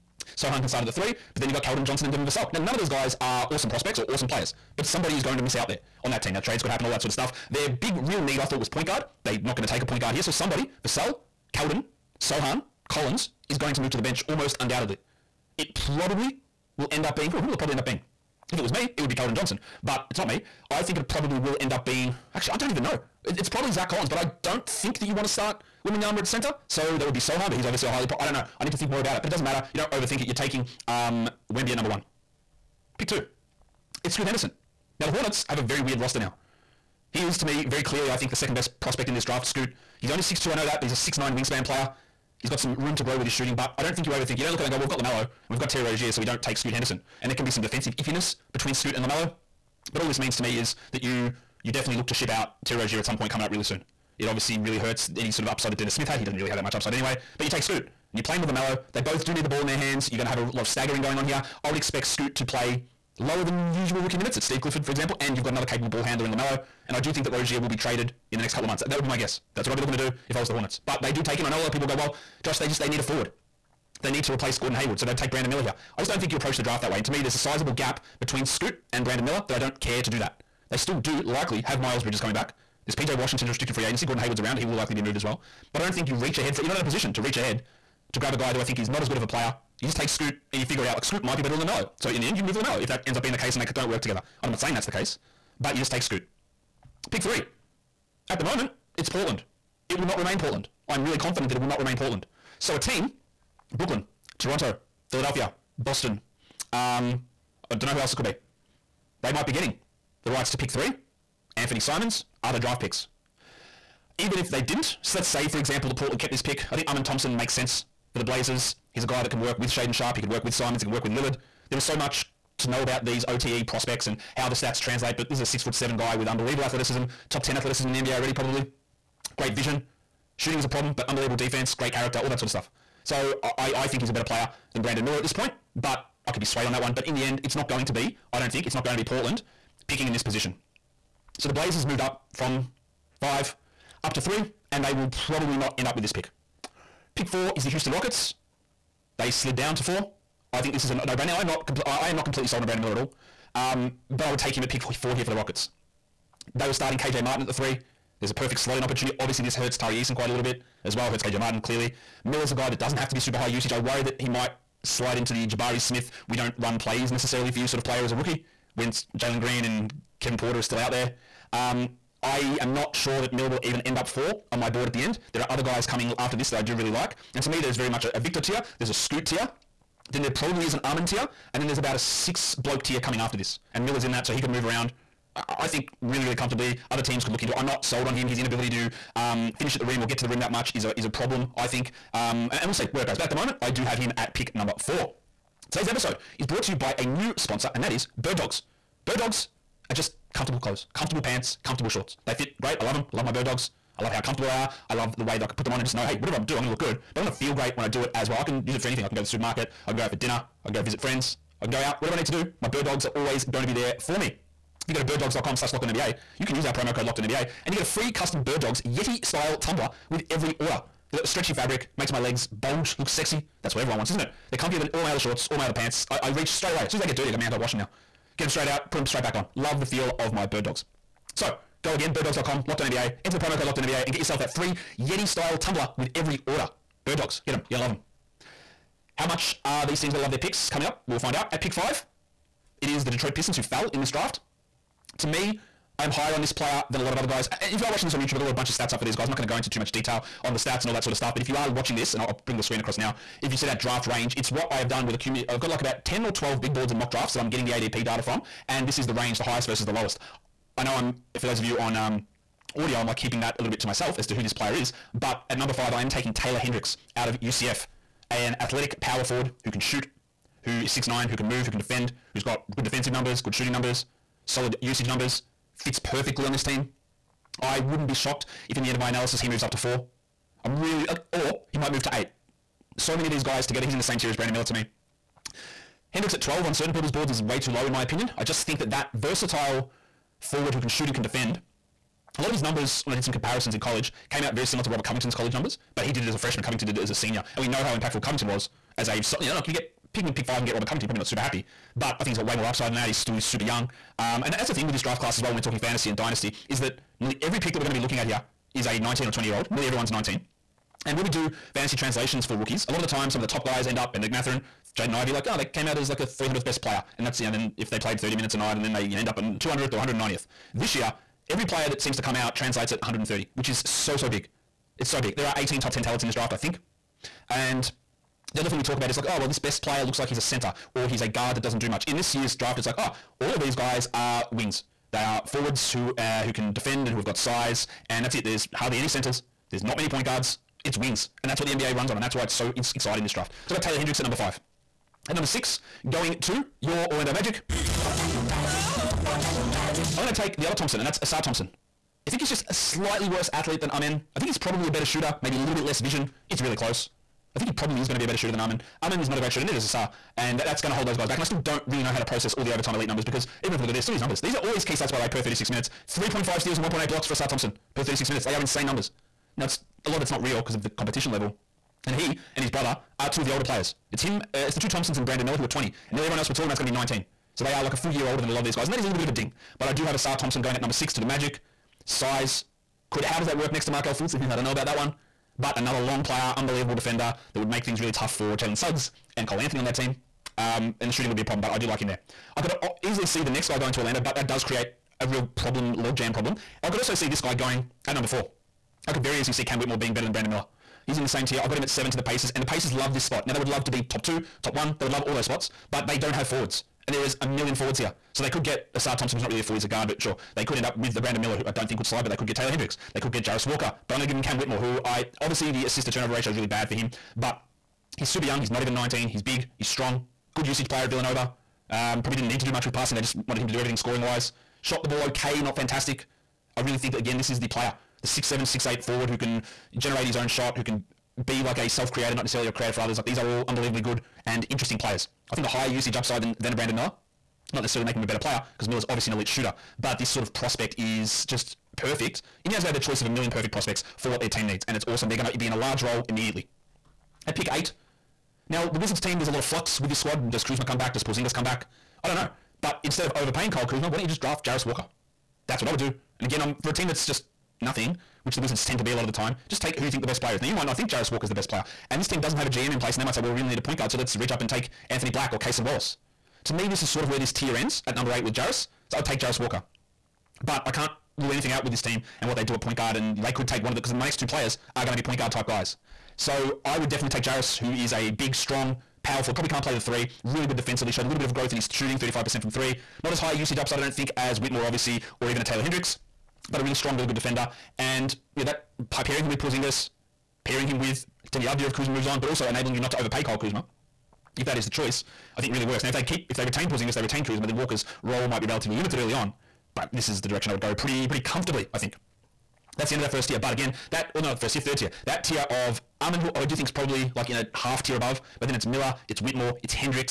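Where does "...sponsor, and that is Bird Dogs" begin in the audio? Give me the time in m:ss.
3:17.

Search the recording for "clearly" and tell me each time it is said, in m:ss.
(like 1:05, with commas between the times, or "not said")
0:37, 2:41.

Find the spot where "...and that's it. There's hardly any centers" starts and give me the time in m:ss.
5:38.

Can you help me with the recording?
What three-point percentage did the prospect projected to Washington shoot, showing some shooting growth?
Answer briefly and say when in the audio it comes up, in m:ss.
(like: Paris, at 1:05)
35%, at 8:02.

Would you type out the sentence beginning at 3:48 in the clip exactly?
Get them straight out, put them straight back on.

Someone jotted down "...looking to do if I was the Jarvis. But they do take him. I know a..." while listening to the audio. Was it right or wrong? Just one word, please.
wrong.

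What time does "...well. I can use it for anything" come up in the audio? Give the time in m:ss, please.
3:28.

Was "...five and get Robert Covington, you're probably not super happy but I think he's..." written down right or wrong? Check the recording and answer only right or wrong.
right.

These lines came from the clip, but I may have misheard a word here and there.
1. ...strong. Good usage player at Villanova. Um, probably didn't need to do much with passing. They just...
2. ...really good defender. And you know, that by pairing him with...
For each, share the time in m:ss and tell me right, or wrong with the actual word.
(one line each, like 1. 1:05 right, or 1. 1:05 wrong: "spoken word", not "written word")
1. 6:59 right
2. 8:07 right.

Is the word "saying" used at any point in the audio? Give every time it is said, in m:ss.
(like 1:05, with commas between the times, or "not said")
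1:34.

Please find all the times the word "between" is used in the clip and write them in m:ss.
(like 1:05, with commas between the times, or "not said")
0:48, 1:18.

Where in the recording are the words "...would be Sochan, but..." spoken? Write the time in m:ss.
0:27.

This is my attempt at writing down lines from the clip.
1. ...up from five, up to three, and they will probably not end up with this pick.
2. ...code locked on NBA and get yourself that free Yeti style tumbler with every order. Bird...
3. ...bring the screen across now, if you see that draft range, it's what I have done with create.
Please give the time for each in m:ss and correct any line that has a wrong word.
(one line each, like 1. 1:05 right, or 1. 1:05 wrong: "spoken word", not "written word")
1. 2:22 right
2. 3:53 right
3. 4:12 wrong: "accumulate", not "create".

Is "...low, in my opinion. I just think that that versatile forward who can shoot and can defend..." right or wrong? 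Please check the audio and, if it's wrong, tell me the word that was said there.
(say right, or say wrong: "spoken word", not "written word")
right.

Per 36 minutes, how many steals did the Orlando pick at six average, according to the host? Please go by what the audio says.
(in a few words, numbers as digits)
3.5.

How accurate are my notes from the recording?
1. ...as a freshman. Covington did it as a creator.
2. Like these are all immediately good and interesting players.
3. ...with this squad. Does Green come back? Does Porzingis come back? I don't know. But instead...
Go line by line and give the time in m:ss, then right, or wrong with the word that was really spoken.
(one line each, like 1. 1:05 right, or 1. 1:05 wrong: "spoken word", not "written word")
1. 4:56 wrong: "senior", not "creator"
2. 7:13 wrong: "unbelievably", not "immediately"
3. 7:30 wrong: "Kuzma", not "Green".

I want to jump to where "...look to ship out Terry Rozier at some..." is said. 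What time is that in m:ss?
0:51.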